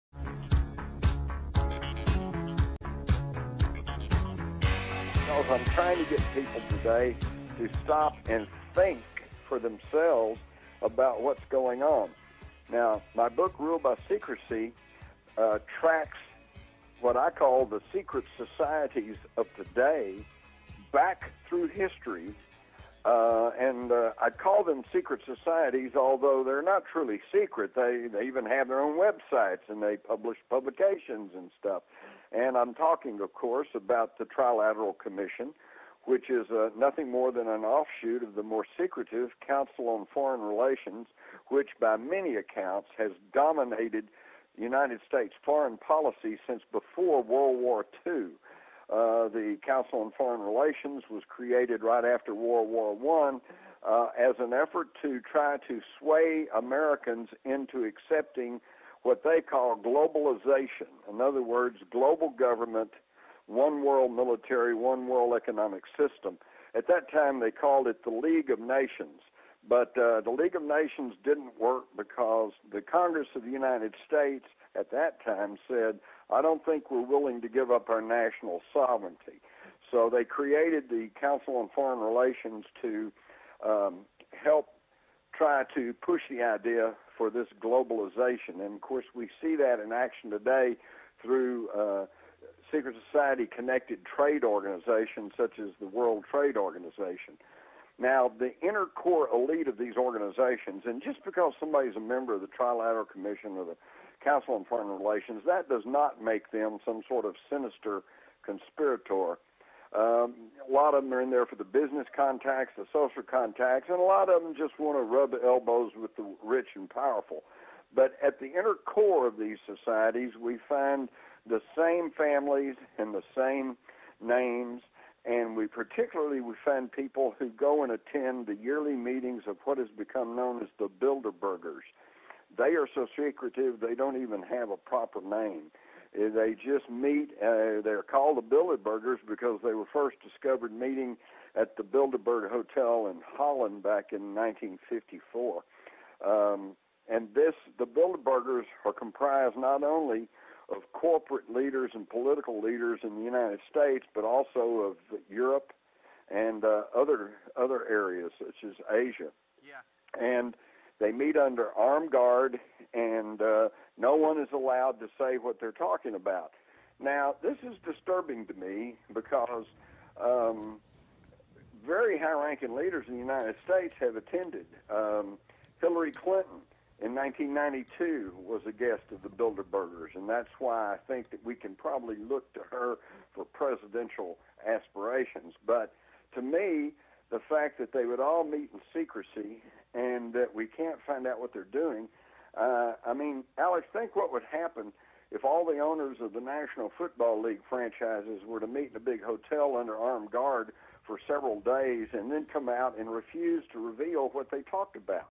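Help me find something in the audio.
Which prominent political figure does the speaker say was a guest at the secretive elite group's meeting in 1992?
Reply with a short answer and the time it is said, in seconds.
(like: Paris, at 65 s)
Hillary Clinton, at 175 s.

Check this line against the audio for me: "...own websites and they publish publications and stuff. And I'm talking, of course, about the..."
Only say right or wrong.
right.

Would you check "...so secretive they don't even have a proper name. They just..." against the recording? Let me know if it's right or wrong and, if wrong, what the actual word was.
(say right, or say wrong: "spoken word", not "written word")
right.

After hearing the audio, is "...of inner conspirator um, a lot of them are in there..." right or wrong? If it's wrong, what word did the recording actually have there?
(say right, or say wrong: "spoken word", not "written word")
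wrong: "sinister", not "inner".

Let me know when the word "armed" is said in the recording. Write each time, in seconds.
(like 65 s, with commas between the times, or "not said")
161 s, 199 s.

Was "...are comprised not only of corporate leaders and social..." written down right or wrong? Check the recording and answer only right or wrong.
wrong.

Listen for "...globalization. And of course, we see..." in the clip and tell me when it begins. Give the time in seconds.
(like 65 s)
87 s.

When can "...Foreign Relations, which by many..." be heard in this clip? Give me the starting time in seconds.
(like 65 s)
40 s.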